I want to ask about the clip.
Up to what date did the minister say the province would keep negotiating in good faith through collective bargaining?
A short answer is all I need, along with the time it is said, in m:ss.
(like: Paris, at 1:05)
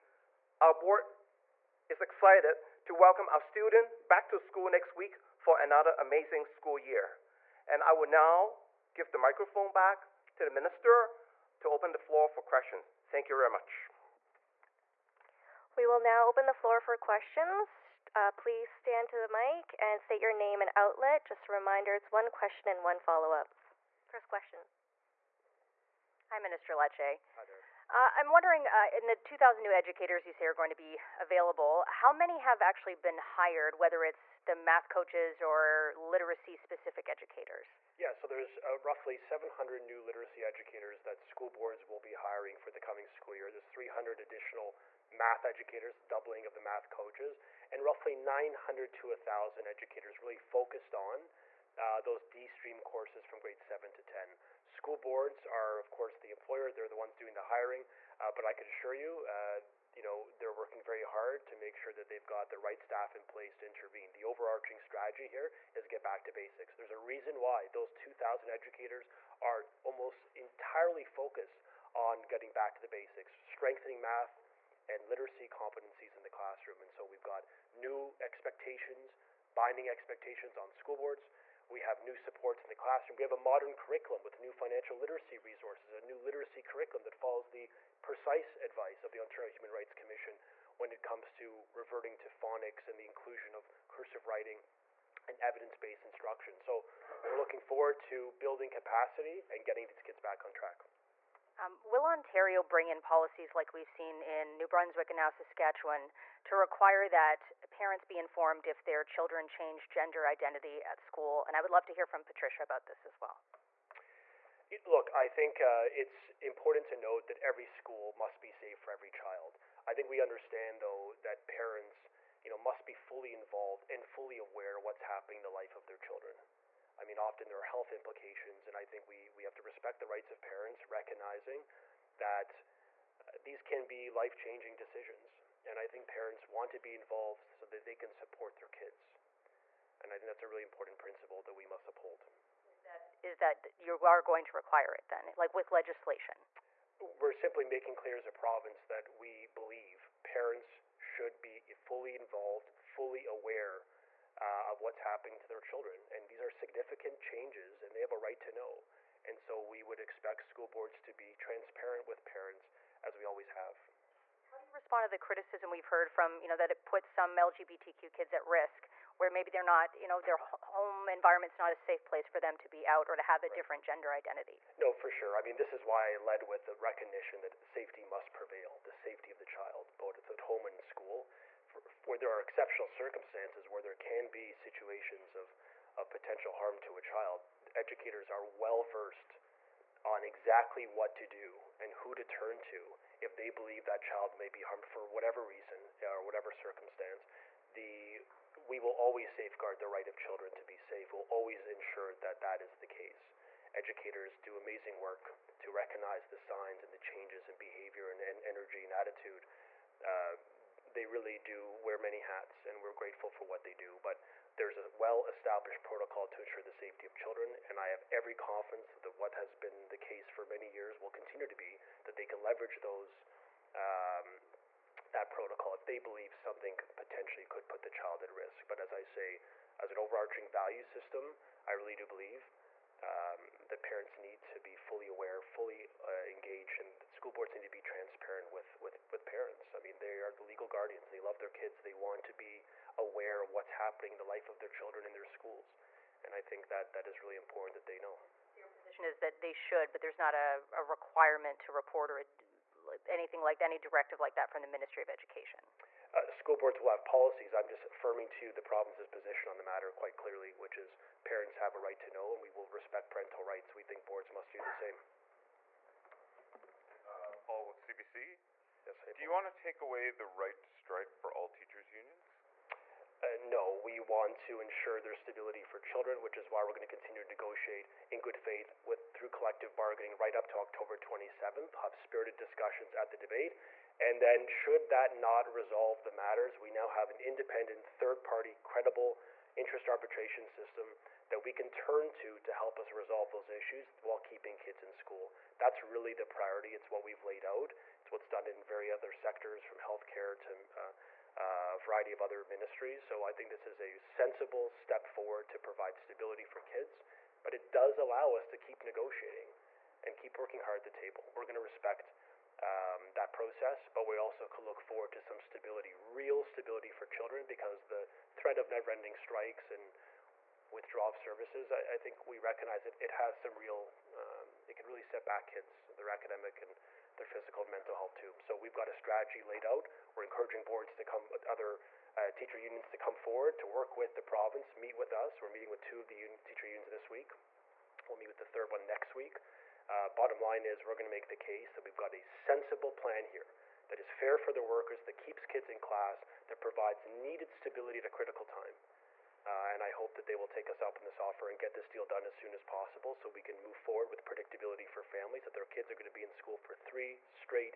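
October 27, at 4:40.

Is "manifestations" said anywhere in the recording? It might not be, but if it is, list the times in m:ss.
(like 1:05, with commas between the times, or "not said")
not said.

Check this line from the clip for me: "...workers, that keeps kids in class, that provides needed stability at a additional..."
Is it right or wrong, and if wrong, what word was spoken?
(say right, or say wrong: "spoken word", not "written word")
wrong: "critical", not "additional".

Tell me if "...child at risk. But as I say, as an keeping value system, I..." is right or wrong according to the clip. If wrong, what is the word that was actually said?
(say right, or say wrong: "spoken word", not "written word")
wrong: "overarching", not "keeping".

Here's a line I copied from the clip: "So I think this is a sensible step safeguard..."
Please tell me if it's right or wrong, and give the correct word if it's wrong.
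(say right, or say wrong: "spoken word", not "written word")
wrong: "forward", not "safeguard".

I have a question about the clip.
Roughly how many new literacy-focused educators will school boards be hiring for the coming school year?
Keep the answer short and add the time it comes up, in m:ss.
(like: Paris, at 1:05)
700, at 0:39.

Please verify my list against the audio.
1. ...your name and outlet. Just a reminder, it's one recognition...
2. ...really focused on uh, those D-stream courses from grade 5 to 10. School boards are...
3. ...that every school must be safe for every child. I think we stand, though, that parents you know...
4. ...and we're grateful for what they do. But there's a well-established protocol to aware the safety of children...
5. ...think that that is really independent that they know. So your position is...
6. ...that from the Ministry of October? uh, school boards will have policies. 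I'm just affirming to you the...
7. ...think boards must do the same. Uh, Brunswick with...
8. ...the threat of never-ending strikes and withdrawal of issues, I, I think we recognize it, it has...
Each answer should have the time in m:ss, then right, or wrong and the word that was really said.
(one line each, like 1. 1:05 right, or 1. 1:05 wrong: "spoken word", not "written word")
1. 0:20 wrong: "question", not "recognition"
2. 0:50 wrong: "7", not "5"
3. 1:57 wrong: "understand", not "stand"
4. 3:32 wrong: "ensure", not "aware"
5. 4:06 wrong: "important", not "independent"
6. 4:14 wrong: "Education", not "October"
7. 4:23 wrong: "Paul", not "Brunswick"
8. 5:17 wrong: "services", not "issues".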